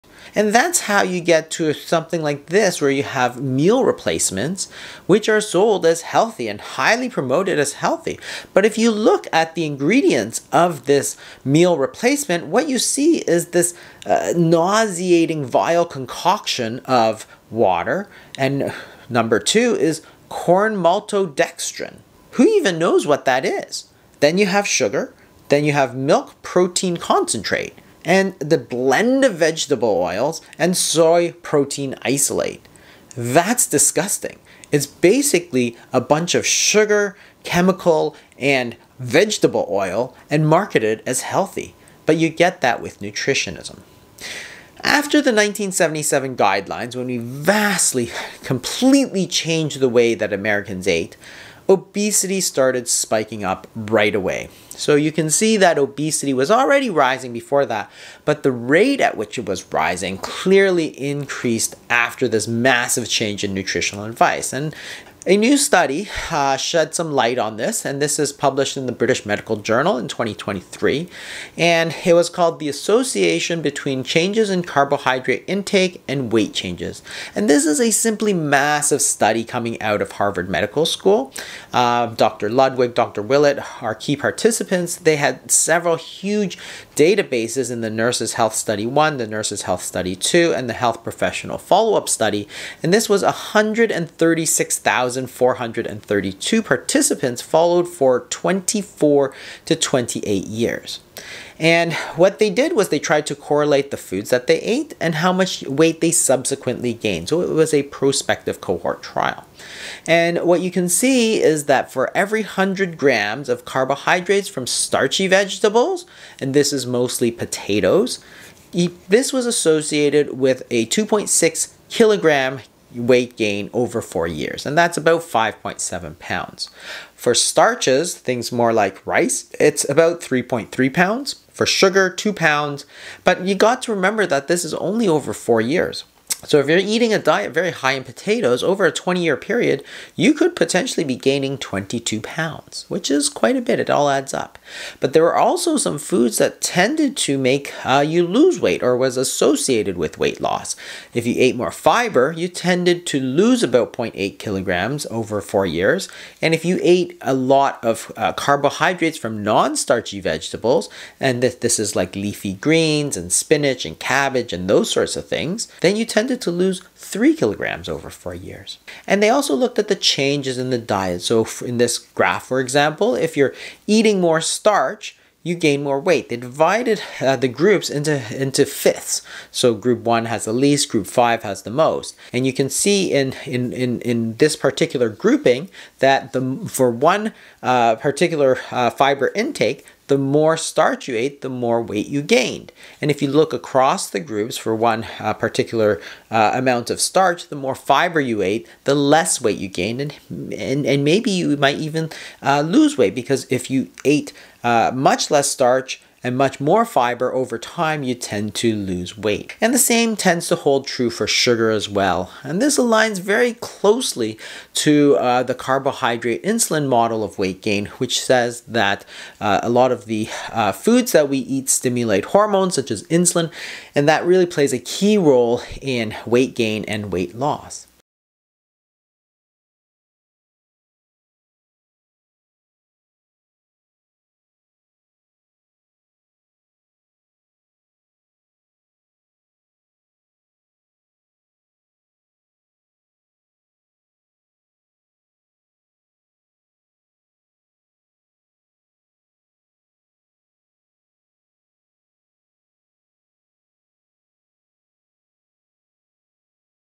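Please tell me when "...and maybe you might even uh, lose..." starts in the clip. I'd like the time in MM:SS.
03:20.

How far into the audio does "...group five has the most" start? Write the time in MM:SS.
03:00.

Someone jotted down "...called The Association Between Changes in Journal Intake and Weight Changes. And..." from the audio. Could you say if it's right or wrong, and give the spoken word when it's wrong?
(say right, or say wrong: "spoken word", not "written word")
wrong: "Carbohydrate", not "Journal".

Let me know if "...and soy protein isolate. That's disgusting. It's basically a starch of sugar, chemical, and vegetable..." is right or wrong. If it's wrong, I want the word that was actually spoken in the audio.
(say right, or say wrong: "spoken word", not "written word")
wrong: "bunch", not "starch".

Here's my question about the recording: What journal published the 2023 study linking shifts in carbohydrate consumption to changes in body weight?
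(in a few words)
British Medical Journal.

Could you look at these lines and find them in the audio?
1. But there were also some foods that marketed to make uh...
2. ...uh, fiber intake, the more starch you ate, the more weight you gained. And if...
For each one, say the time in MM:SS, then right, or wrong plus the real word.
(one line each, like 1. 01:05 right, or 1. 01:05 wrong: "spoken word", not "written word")
1. 02:24 wrong: "tended", not "marketed"
2. 03:08 right.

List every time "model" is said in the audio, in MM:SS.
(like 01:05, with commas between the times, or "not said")
03:36.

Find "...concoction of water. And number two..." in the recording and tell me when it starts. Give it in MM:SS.
00:15.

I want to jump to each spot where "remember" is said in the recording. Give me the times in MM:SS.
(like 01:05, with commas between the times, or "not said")
02:13.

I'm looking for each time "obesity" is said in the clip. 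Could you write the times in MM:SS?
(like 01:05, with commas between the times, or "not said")
00:51, 00:55.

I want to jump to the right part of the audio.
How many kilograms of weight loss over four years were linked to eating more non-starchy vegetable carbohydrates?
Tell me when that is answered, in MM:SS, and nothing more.
02:46.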